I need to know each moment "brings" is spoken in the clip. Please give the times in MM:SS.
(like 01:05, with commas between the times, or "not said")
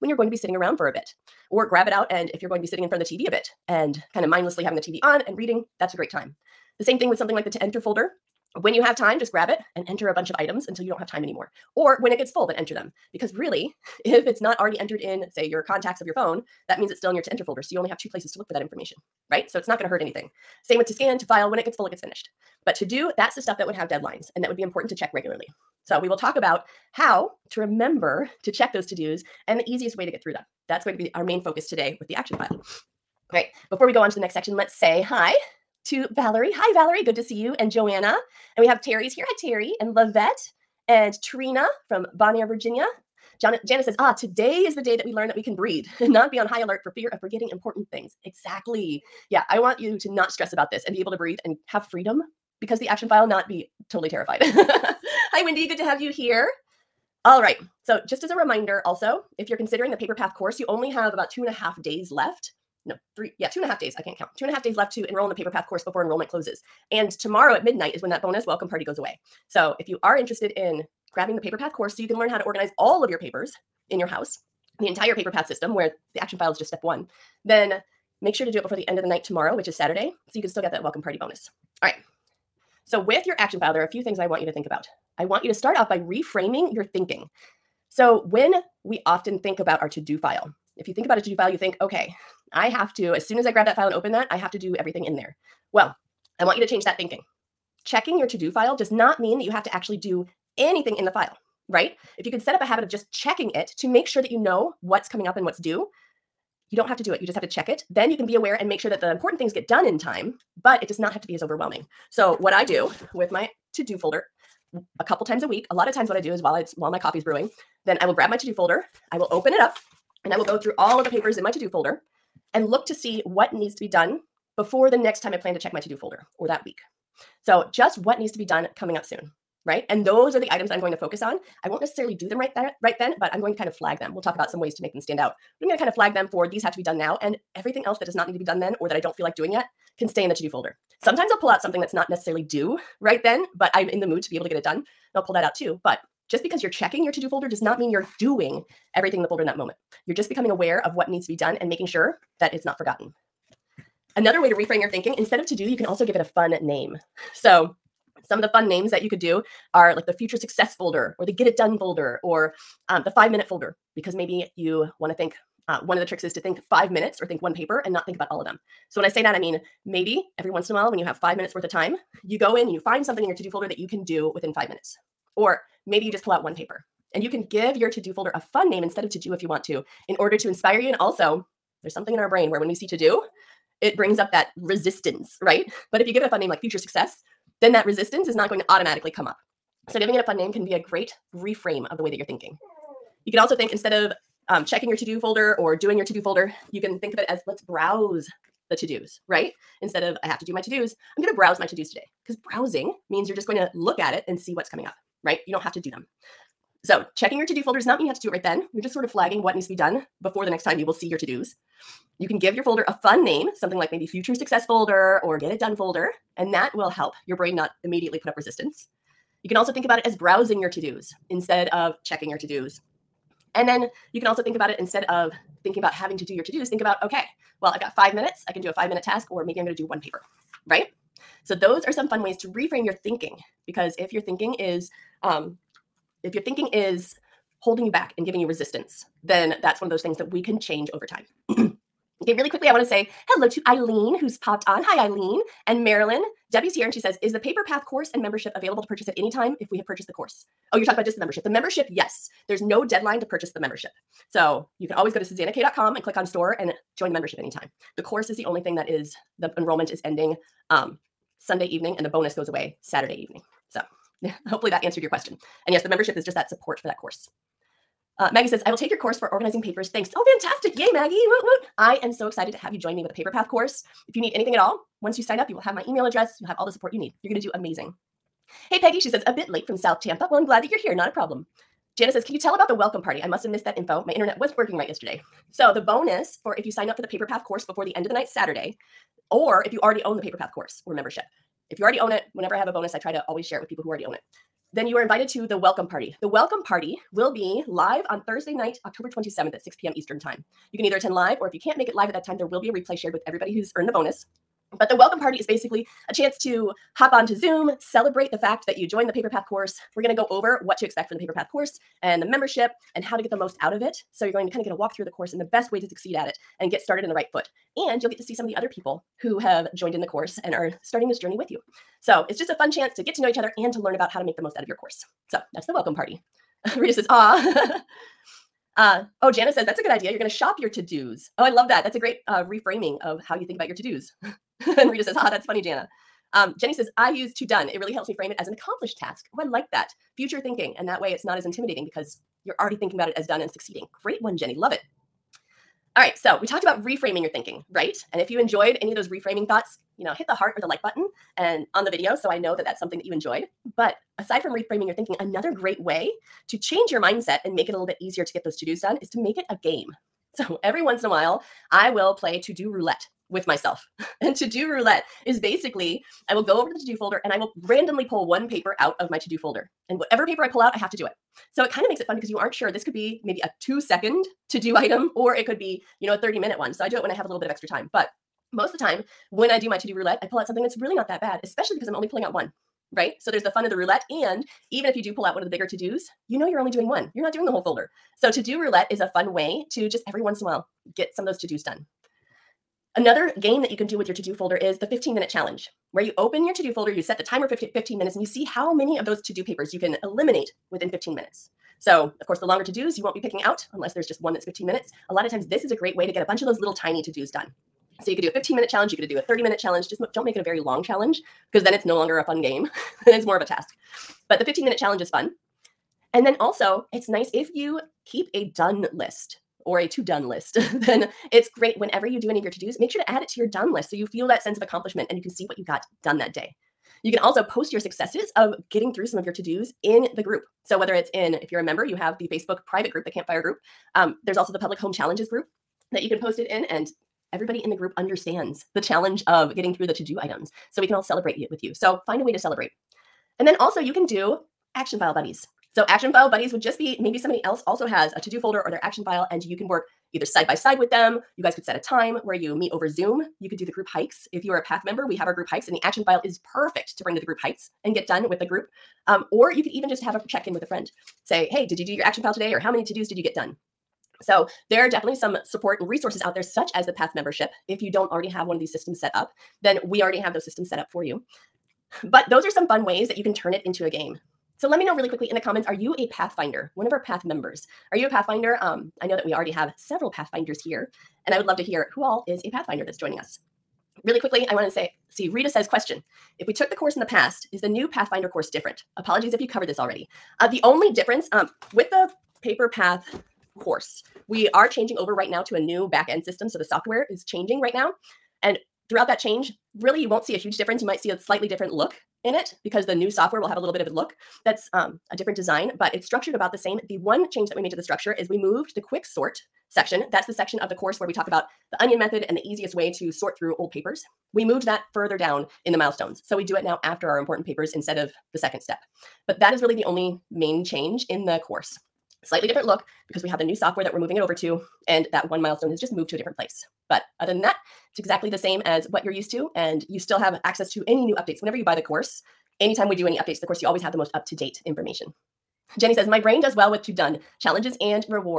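03:03, 07:37.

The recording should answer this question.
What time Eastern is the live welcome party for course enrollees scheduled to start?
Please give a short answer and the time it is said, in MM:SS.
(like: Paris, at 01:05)
6 p.m., at 04:59.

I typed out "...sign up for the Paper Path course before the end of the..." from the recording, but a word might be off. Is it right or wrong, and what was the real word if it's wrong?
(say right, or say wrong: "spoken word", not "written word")
right.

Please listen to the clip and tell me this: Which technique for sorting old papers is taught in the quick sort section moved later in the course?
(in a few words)
onion method.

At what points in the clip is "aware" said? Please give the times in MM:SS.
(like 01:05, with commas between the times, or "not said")
01:48, 02:30.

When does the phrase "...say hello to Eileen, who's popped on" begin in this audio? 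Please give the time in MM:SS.
04:02.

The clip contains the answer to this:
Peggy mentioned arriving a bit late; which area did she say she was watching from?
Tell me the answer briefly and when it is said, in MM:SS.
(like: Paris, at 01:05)
South Tampa, at 04:39.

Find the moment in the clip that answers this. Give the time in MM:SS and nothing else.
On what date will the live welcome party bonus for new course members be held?
04:58.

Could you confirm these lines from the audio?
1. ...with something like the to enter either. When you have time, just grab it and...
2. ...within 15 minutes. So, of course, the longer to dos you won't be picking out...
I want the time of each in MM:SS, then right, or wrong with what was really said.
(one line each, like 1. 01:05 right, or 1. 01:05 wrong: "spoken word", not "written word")
1. 00:07 wrong: "folder", not "either"
2. 06:40 right.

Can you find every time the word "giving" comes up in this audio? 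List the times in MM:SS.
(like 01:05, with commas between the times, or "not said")
03:09, 03:58.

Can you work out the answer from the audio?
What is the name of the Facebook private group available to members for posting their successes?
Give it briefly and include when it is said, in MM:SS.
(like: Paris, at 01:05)
Campfire group, at 07:13.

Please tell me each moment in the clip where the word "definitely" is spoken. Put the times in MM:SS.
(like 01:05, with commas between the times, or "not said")
07:44.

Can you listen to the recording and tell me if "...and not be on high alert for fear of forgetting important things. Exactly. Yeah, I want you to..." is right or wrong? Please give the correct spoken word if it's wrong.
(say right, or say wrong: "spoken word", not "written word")
right.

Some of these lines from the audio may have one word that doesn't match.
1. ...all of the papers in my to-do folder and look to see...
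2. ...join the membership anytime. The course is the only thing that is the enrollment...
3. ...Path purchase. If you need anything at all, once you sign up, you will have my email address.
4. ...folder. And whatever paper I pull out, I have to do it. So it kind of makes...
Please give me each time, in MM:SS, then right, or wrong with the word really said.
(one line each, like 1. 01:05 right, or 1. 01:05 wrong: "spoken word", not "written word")
1. 02:00 right
2. 04:16 right
3. 04:33 wrong: "course", not "purchase"
4. 06:09 right.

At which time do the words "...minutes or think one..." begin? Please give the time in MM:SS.
02:46.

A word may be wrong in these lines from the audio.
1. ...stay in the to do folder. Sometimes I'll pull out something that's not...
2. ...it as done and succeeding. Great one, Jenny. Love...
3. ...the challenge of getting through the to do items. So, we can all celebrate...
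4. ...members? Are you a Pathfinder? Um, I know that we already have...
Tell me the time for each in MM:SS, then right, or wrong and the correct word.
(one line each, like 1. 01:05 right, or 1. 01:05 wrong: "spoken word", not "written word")
1. 02:20 right
2. 05:43 right
3. 07:18 right
4. 07:57 right.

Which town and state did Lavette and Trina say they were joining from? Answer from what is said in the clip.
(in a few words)
Bon Air, Virginia.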